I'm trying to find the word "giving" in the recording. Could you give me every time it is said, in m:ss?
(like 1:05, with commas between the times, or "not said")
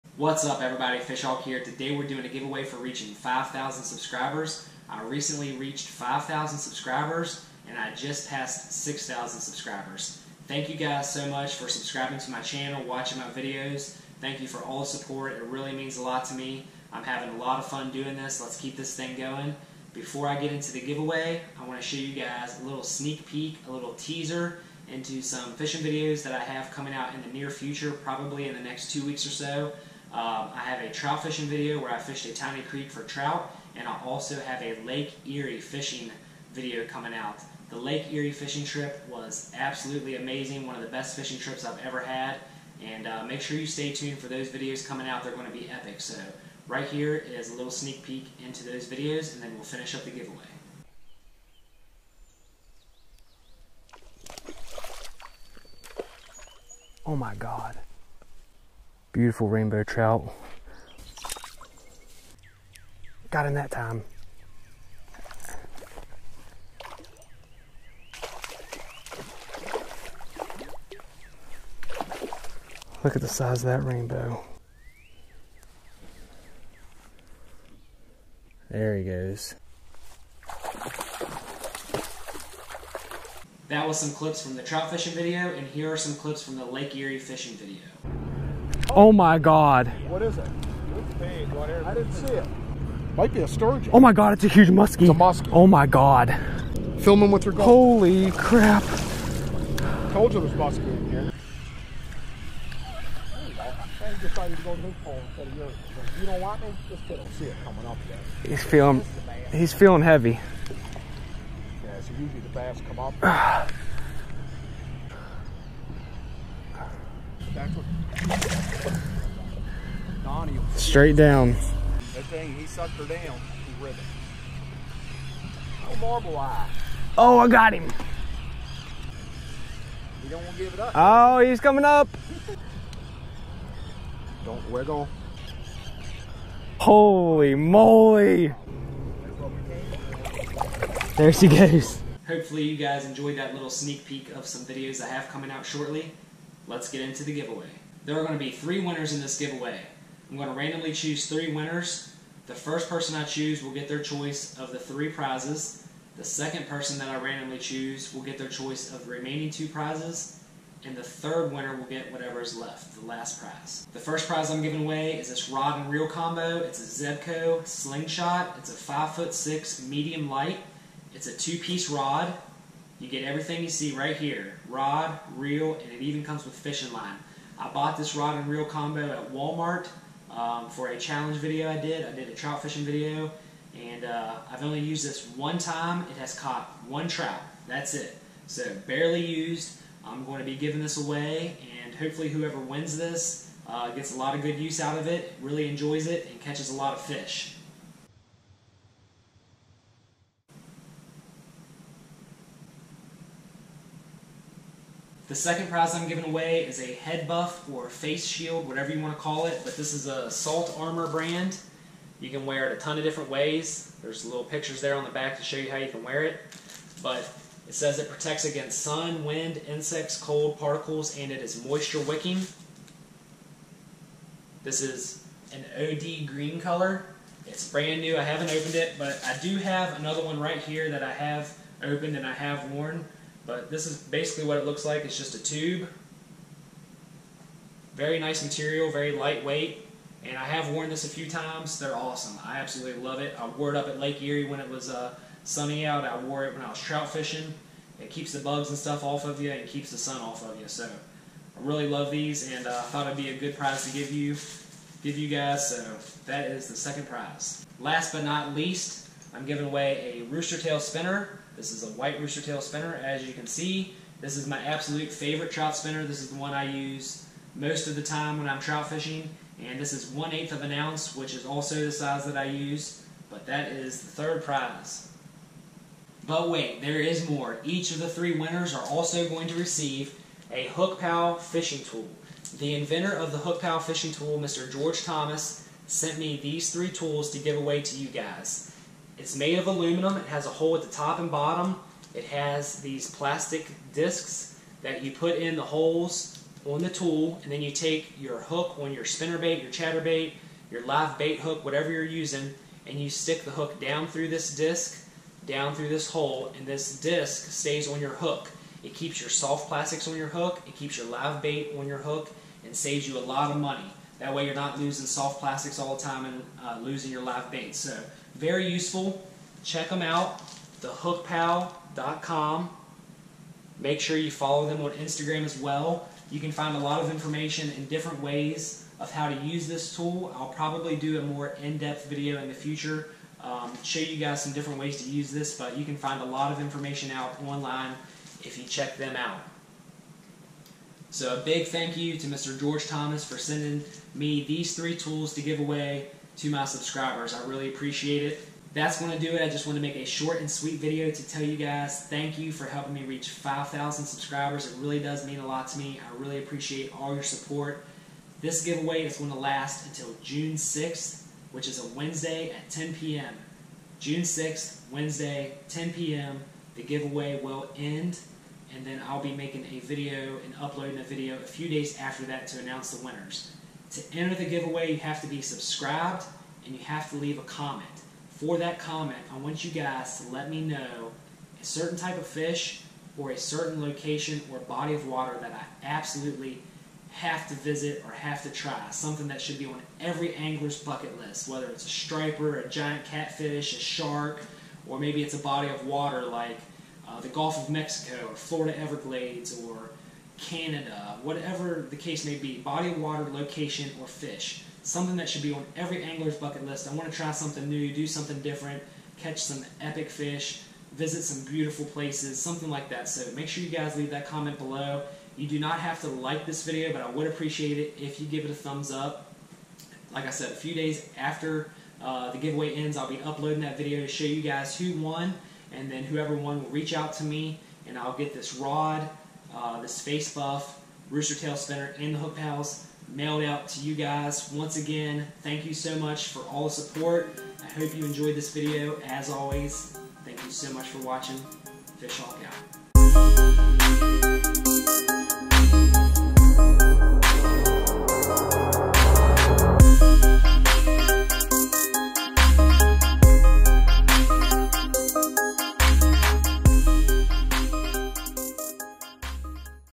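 2:44, 3:10, 3:26, 4:19.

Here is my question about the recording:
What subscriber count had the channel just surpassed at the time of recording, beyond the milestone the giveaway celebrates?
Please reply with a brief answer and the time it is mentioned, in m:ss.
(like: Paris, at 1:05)
6,000, at 0:08.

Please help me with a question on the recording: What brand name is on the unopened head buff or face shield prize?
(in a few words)
Salt Armor.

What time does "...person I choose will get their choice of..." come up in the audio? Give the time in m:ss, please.
2:32.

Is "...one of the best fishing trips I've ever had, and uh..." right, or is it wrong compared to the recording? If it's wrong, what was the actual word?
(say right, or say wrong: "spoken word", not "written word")
right.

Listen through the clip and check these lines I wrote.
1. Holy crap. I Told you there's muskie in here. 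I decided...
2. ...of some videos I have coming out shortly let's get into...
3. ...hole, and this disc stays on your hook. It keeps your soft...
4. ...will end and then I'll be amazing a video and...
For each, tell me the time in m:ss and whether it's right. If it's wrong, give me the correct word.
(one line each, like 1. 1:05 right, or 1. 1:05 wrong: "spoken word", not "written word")
1. 1:37 right
2. 2:24 right
3. 5:06 right
4. 6:07 wrong: "making", not "amazing".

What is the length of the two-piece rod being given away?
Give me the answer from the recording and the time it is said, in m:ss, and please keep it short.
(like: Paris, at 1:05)
5'6, at 2:48.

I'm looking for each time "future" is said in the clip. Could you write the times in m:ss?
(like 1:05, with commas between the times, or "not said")
0:27, 5:32.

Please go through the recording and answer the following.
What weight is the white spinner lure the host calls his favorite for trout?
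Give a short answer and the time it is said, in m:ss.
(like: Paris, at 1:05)
1/8 ounce, at 4:30.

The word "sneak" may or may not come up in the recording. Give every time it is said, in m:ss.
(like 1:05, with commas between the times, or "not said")
0:22, 0:47, 2:23.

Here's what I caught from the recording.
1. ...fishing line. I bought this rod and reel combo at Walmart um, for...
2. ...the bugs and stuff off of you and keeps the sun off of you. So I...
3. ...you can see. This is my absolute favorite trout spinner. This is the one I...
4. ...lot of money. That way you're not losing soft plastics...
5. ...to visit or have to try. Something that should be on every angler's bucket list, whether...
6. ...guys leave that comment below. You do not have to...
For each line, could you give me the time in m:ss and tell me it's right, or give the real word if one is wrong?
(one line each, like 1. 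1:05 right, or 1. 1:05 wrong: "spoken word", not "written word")
1. 2:56 right
2. 4:08 right
3. 4:23 right
4. 5:13 right
5. 6:27 right
6. 6:53 right.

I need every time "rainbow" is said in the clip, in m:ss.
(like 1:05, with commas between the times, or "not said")
0:59, 1:13.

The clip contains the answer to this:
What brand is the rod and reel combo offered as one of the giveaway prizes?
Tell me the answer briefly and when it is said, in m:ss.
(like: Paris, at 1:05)
Zebco, at 2:47.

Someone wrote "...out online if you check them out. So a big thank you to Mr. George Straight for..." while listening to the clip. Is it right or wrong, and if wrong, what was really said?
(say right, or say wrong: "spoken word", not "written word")
wrong: "Thomas", not "Straight".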